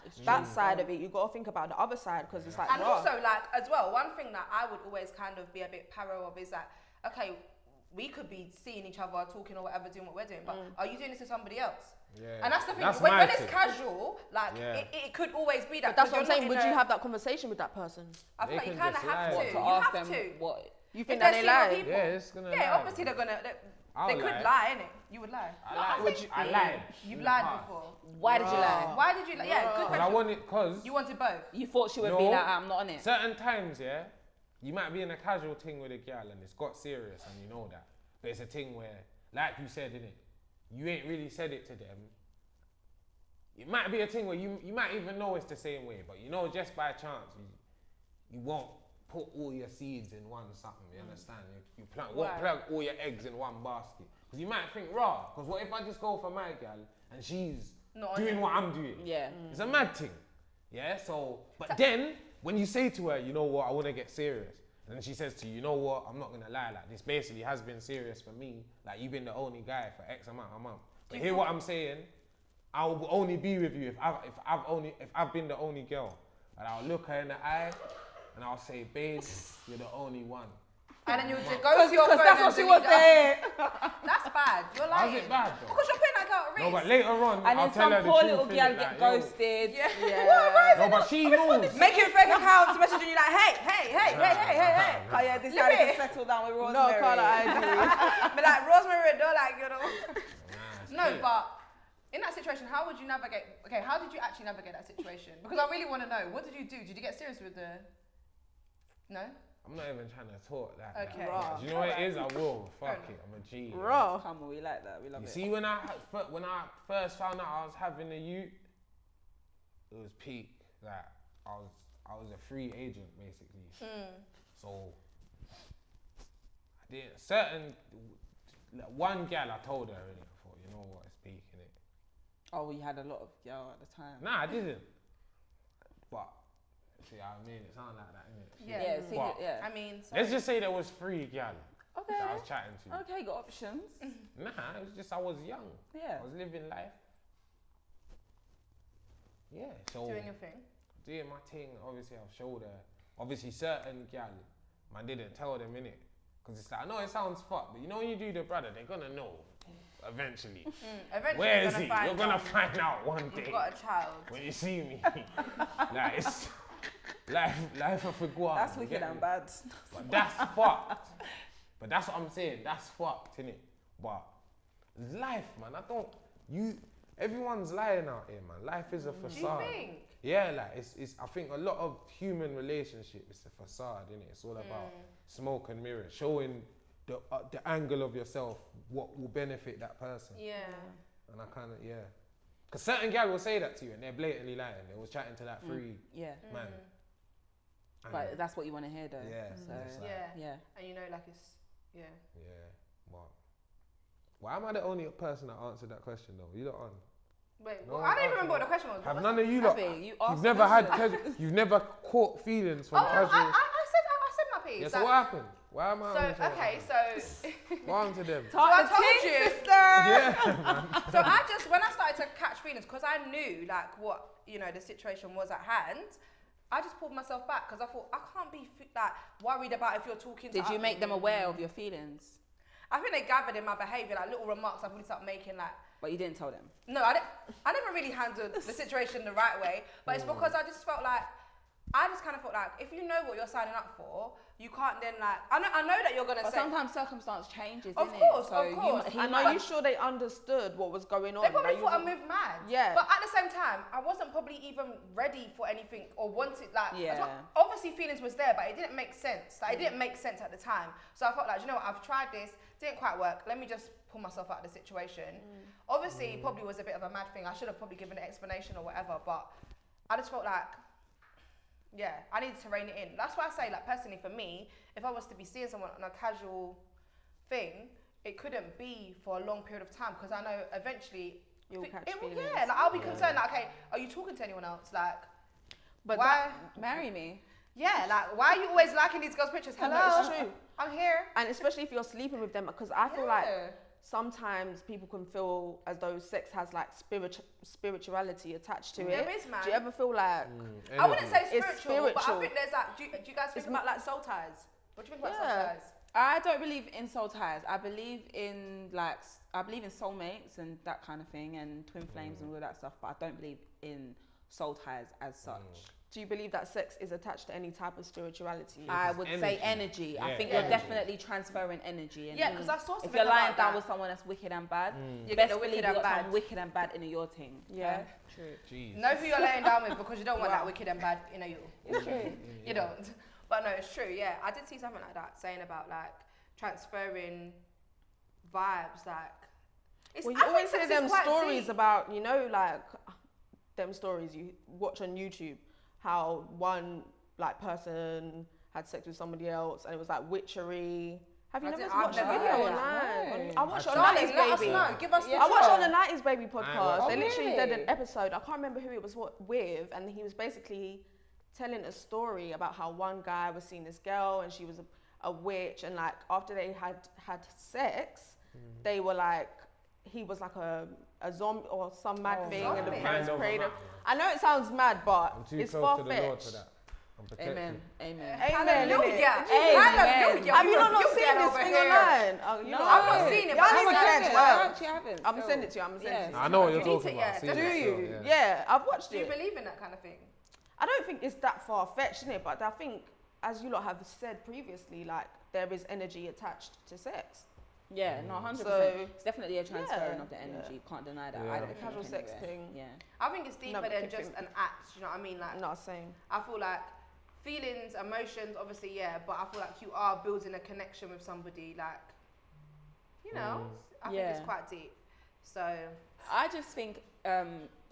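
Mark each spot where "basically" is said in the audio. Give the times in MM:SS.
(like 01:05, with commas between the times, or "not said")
01:07, 02:03, 06:00.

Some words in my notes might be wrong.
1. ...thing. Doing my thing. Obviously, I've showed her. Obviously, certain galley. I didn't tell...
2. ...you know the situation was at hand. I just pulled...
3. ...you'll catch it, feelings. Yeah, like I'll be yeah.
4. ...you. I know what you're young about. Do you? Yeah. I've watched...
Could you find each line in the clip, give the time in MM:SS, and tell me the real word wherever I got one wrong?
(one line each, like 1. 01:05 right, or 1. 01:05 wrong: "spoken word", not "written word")
1. 02:30 right
2. 03:44 right
3. 04:41 right
4. 06:26 wrong: "talking", not "young".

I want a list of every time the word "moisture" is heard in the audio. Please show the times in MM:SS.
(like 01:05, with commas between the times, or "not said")
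not said.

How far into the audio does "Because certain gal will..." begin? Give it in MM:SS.
03:12.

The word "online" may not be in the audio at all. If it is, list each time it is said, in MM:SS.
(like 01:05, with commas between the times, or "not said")
05:52, 06:21.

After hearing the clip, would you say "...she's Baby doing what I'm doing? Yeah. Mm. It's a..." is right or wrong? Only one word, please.
wrong.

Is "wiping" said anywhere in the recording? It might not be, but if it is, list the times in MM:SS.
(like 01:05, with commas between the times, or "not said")
not said.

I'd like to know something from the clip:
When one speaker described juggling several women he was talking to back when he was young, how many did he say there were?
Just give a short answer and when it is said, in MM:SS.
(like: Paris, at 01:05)
3, at 02:20.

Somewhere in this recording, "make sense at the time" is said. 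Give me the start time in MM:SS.
04:20.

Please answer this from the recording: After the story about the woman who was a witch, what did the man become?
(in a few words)
a zombie.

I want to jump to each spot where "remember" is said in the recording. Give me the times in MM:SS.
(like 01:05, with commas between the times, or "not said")
03:28, 05:58.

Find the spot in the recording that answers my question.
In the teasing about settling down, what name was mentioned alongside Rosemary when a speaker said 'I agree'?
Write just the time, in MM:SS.
01:37.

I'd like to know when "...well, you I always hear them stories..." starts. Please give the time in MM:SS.
05:40.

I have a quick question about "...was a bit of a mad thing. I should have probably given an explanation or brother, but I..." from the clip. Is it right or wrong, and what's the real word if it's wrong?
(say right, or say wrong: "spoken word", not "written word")
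wrong: "whatever", not "brother".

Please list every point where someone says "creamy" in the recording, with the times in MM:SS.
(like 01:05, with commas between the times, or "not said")
not said.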